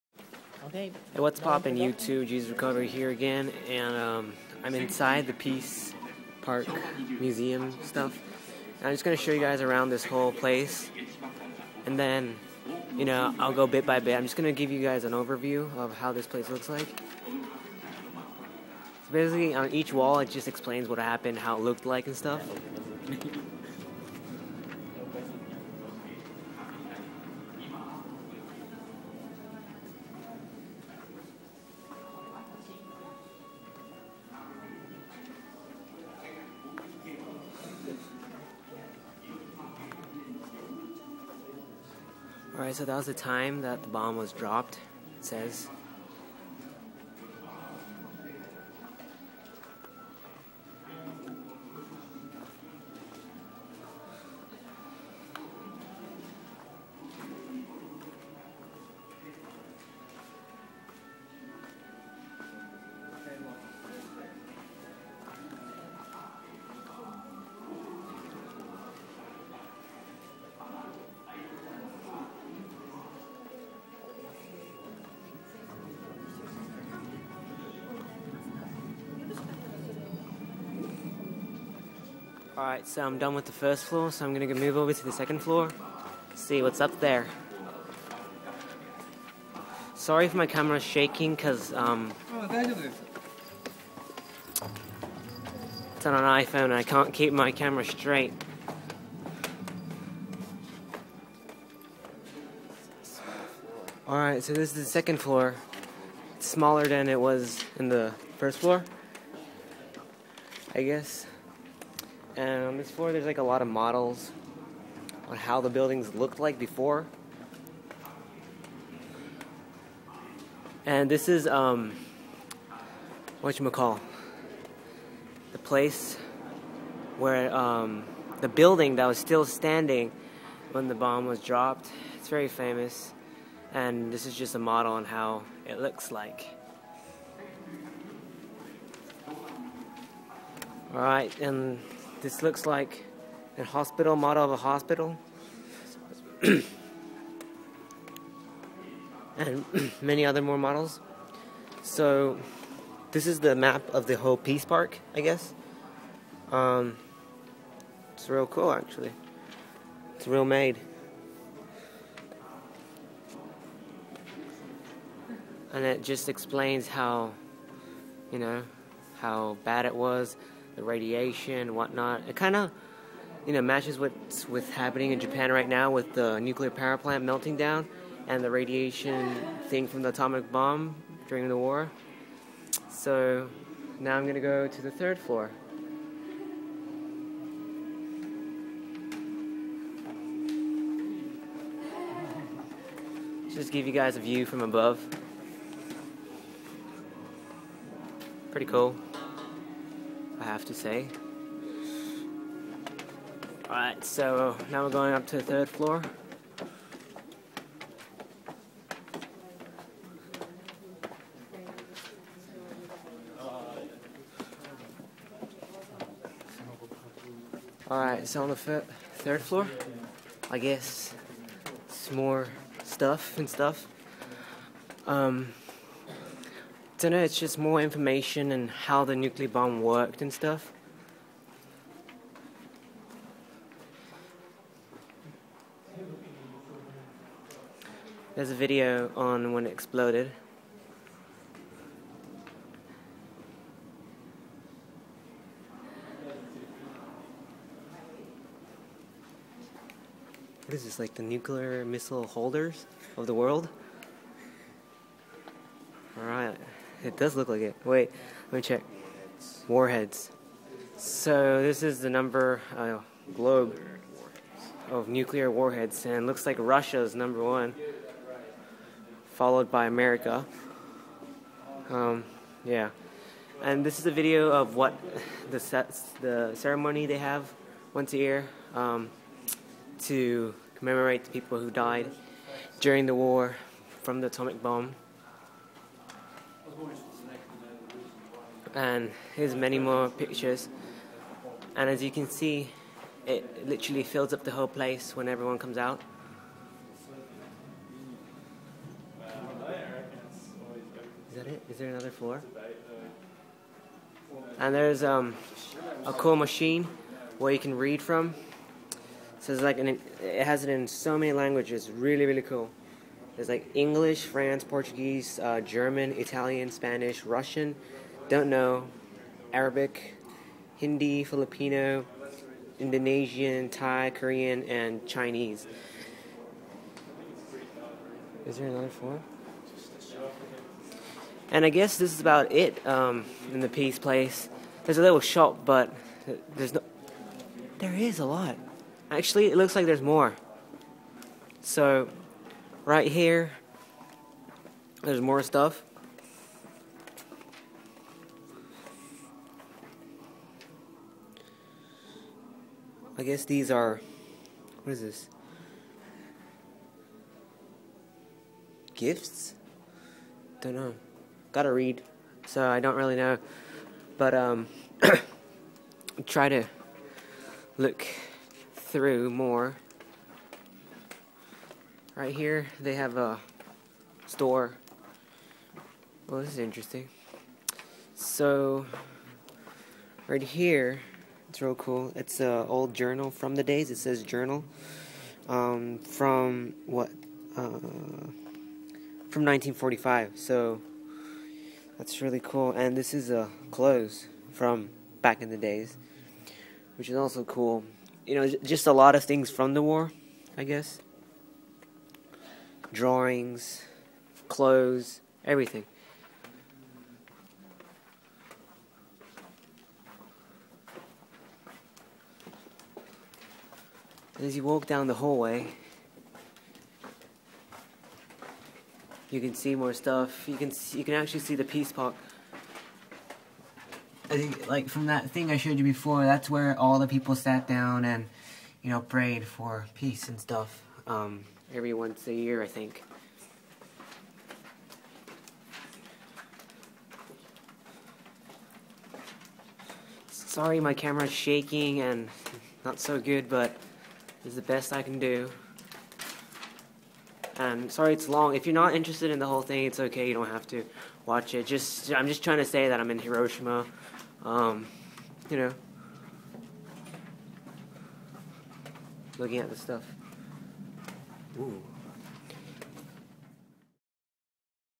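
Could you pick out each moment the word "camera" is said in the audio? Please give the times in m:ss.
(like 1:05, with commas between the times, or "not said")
1:30, 1:37, 7:20.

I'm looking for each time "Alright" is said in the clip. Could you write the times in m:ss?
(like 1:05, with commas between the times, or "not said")
0:42, 1:22, 1:44, 3:23, 3:37, 4:16.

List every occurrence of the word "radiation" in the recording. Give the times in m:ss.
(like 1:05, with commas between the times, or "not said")
2:50, 2:58.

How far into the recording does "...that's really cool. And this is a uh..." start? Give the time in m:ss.
6:31.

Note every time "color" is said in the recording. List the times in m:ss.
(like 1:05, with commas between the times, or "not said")
not said.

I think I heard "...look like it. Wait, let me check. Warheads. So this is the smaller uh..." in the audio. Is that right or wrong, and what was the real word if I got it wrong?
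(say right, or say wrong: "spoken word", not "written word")
wrong: "number", not "smaller".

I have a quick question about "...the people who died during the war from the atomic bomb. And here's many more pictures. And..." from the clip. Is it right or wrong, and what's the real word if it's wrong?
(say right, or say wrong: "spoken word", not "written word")
right.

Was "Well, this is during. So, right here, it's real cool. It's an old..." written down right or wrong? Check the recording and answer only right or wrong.
wrong.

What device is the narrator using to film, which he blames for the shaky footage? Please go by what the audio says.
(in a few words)
iPhone.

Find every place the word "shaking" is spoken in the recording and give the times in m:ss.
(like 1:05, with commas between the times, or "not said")
1:30, 7:21.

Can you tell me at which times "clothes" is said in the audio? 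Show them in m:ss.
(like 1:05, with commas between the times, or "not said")
6:33, 6:44.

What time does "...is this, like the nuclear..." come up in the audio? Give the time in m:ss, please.
4:10.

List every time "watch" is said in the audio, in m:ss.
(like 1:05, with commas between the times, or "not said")
7:31.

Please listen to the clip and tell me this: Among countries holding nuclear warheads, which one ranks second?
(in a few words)
America.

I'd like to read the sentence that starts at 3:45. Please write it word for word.
Um, don't know, it's just more information and how the nuclear bomb worked and stuff.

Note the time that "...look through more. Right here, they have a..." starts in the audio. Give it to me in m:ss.
6:07.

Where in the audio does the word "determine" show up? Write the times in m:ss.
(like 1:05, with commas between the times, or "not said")
not said.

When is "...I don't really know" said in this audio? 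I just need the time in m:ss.
6:02.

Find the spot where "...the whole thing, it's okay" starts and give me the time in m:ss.
7:29.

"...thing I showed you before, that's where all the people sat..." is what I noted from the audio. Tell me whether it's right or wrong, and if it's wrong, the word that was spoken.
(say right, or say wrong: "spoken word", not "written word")
right.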